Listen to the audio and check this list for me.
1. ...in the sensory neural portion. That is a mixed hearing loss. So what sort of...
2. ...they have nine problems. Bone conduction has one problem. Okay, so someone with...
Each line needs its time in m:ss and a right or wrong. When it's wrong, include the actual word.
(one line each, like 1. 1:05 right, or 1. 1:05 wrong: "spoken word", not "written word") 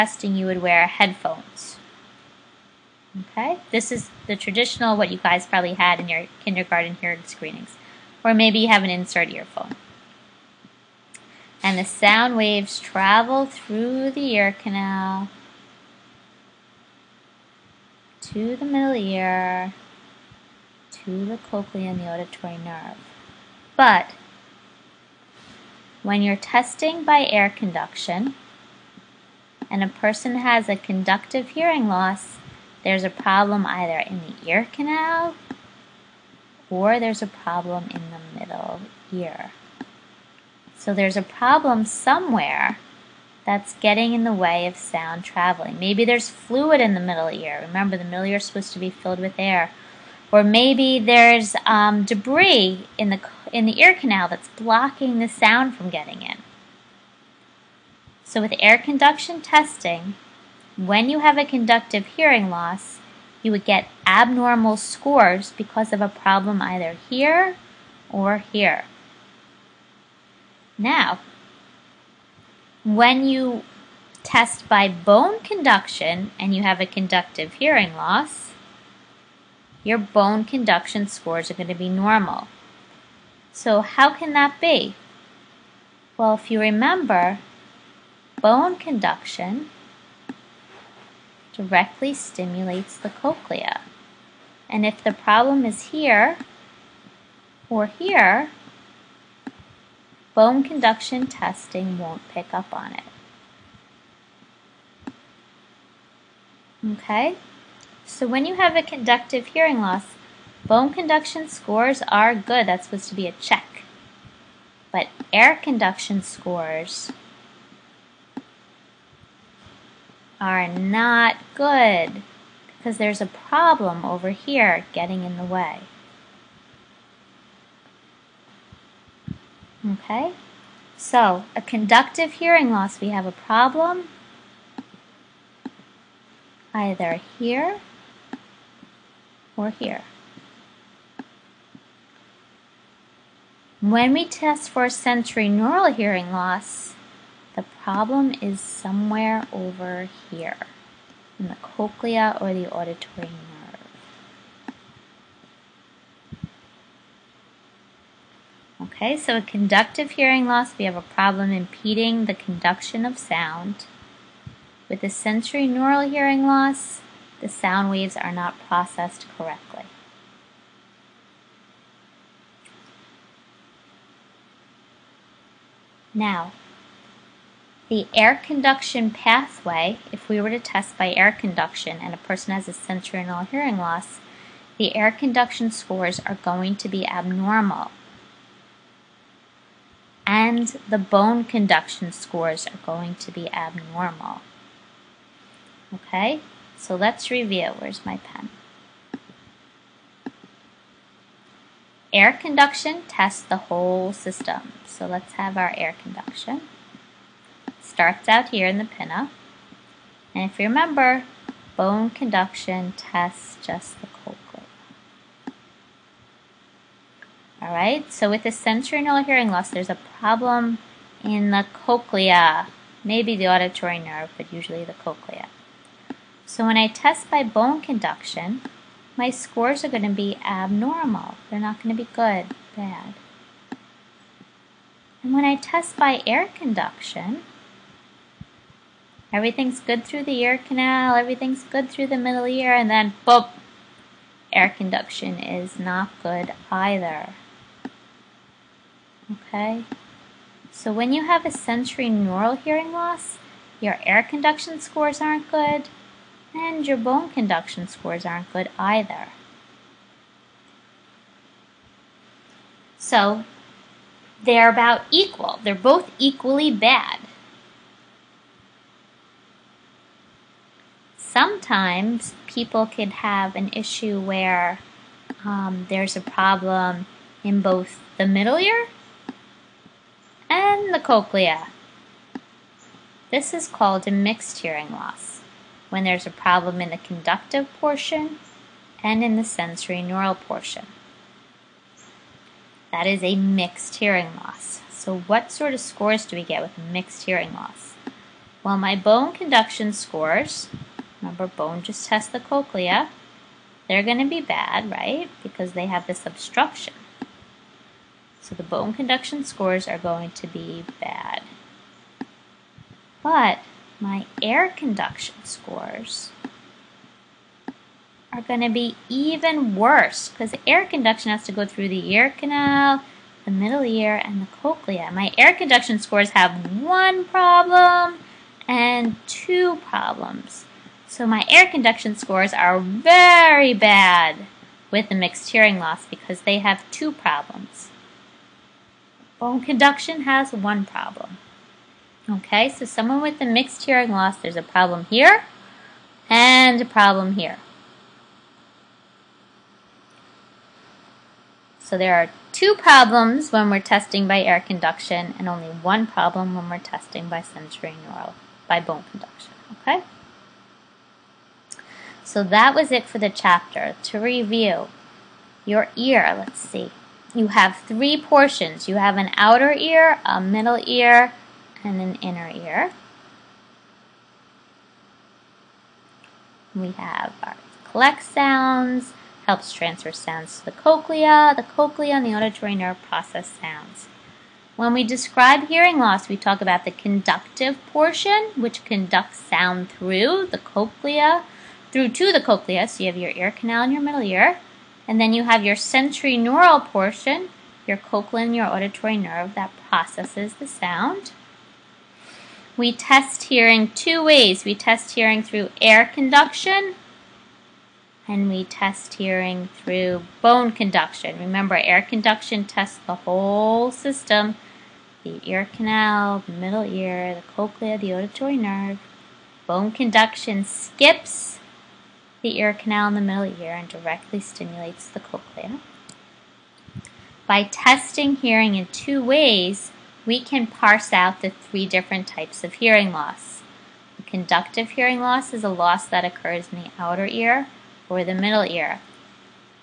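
1. 4:49 right
2. 5:36 wrong: "two", not "nine".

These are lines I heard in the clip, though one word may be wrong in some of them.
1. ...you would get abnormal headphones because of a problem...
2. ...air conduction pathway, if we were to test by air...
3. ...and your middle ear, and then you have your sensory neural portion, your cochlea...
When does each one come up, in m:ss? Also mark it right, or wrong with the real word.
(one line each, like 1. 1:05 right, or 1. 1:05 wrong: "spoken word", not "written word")
1. 1:03 wrong: "scores", not "headphones"
2. 2:58 right
3. 6:33 right.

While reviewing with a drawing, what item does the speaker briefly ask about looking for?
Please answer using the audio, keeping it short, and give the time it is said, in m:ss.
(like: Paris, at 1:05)
pen, at 3:18.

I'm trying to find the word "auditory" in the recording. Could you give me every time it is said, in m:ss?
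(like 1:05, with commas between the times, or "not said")
0:22, 2:32, 3:43, 6:22, 6:38, 6:58.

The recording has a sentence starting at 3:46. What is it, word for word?
So when I test by bone conduction, my scores are going to be abnormal.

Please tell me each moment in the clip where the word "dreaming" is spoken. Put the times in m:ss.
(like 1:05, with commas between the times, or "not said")
not said.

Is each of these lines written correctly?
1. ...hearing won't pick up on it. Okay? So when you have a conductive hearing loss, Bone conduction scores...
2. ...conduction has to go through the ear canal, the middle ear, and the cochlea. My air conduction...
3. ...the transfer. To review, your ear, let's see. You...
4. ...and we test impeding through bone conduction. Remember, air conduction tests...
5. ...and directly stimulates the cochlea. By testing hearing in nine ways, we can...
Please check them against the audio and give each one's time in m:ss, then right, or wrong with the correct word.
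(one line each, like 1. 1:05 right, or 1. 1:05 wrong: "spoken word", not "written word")
1. 1:41 wrong: "testing", not "hearing"
2. 5:20 right
3. 6:03 wrong: "chapter", not "transfer"
4. 6:48 wrong: "hearing", not "impeding"
5. 7:03 wrong: "two", not "nine".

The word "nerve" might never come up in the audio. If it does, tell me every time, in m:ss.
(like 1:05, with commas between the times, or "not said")
0:22, 2:33, 3:43, 6:22, 6:39, 6:58.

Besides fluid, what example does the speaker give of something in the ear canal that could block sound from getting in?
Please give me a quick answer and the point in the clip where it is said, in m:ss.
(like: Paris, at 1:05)
debris, at 0:52.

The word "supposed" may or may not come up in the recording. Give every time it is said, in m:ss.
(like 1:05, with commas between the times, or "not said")
0:48, 1:52.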